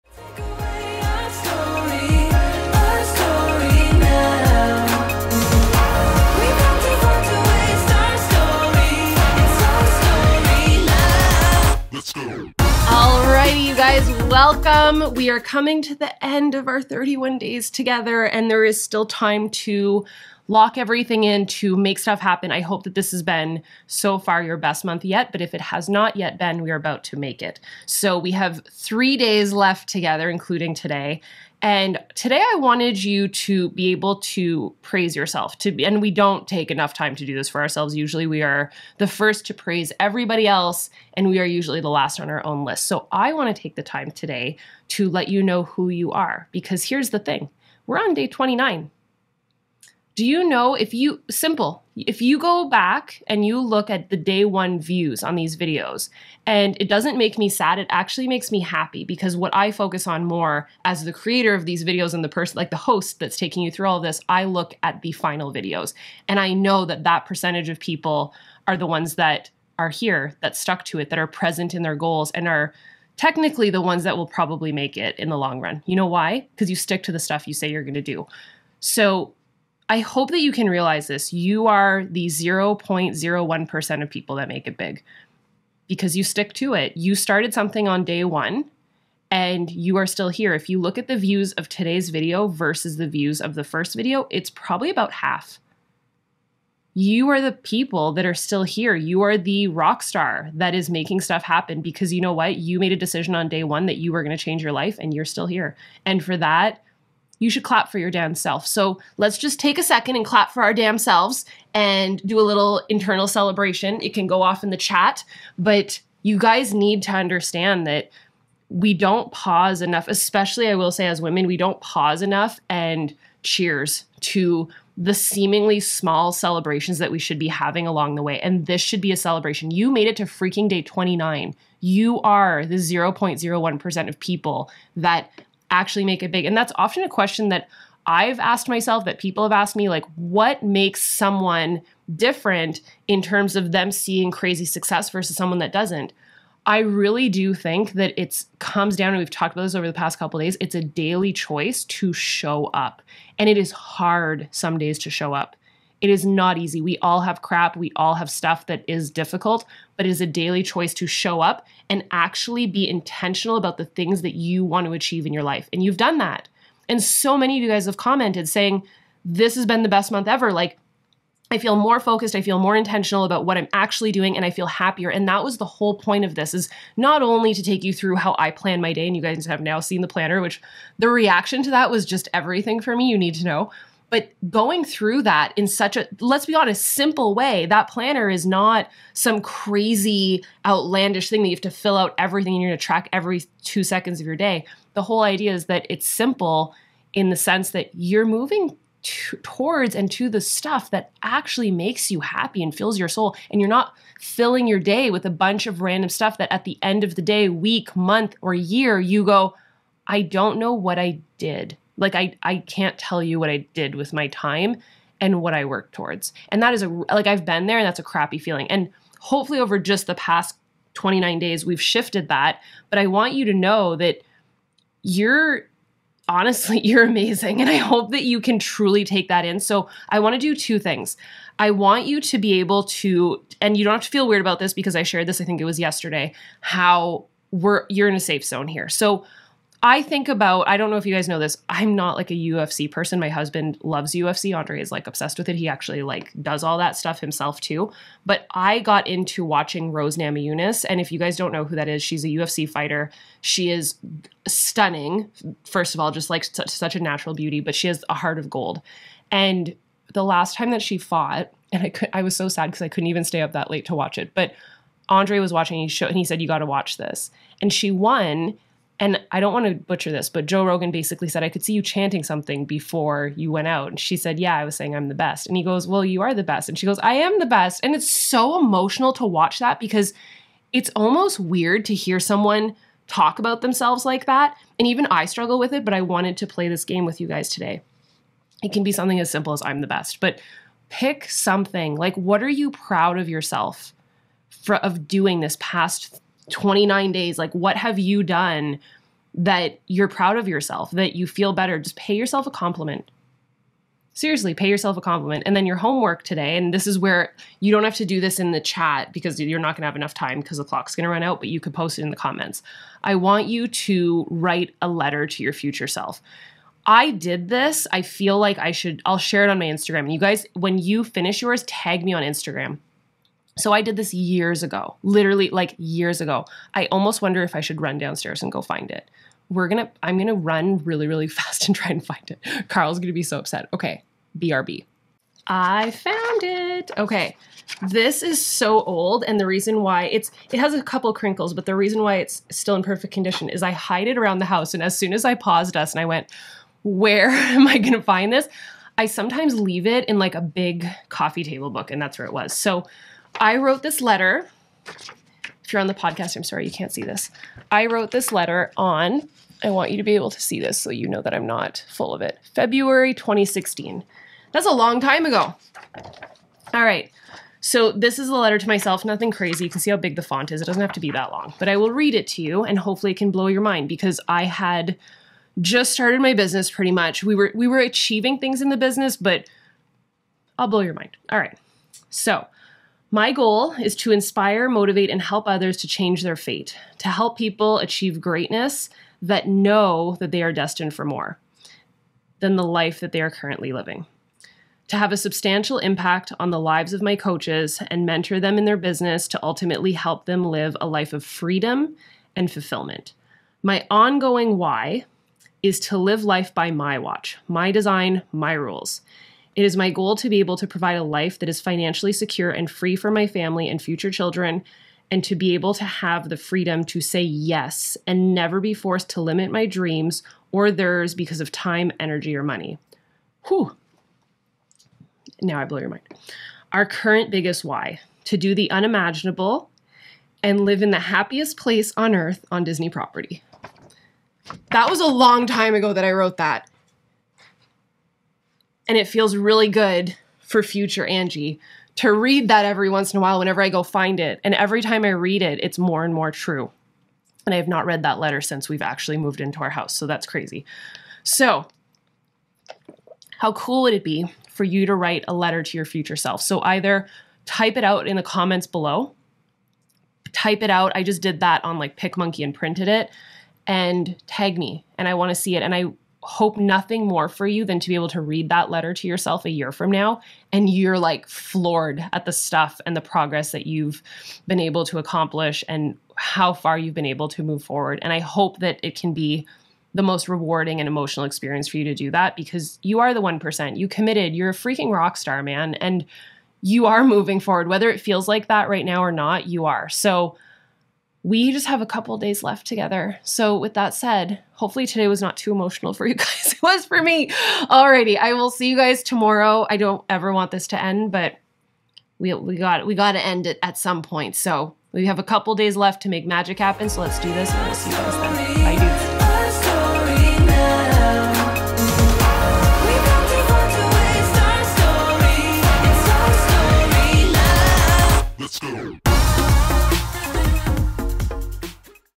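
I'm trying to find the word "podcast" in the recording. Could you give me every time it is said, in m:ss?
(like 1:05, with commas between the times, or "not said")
5:55.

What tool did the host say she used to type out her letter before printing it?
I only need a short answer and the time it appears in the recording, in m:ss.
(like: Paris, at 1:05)
PicMonkey, at 7:41.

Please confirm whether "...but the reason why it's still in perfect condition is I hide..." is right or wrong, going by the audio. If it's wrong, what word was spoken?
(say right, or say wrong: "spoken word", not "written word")
right.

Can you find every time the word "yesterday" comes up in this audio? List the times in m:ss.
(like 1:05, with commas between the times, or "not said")
3:55.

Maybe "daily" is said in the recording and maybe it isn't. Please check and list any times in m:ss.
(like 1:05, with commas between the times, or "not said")
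2:30, 2:40.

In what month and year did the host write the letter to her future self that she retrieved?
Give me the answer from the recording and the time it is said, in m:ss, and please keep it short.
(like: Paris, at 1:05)
February 2016, at 6:02.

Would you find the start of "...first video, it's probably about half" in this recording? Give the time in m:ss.
1:33.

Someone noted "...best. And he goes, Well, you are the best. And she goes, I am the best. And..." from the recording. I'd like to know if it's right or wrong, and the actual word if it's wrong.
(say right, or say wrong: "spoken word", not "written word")
right.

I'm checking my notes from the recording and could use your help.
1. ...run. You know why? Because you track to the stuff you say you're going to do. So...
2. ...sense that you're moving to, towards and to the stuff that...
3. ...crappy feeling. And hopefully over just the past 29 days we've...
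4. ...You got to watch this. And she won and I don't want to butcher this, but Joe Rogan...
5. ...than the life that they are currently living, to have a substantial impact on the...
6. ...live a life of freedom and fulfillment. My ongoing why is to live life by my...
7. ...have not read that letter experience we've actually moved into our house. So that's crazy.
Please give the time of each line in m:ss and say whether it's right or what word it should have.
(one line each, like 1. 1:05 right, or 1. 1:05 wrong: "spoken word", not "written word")
1. 1:15 wrong: "stick", not "track"
2. 3:17 right
3. 3:38 right
4. 4:26 right
5. 6:32 right
6. 6:40 right
7. 7:27 wrong: "since", not "experience".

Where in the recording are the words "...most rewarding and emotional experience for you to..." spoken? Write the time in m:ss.
8:00.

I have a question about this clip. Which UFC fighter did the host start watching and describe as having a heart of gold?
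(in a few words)
Rose Namajunas.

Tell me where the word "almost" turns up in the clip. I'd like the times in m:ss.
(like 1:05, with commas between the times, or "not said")
4:40, 5:26.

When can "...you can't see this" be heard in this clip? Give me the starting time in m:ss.
5:56.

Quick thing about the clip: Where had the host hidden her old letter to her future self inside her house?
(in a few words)
a big coffee table book.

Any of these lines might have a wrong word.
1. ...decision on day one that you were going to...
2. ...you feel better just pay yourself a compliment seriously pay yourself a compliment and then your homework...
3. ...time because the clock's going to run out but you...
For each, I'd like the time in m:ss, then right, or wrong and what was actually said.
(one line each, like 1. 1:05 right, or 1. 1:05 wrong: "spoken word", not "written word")
1. 1:42 right
2. 5:01 right
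3. 5:10 right.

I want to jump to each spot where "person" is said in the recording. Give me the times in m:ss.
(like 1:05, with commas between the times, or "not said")
1:02, 4:02.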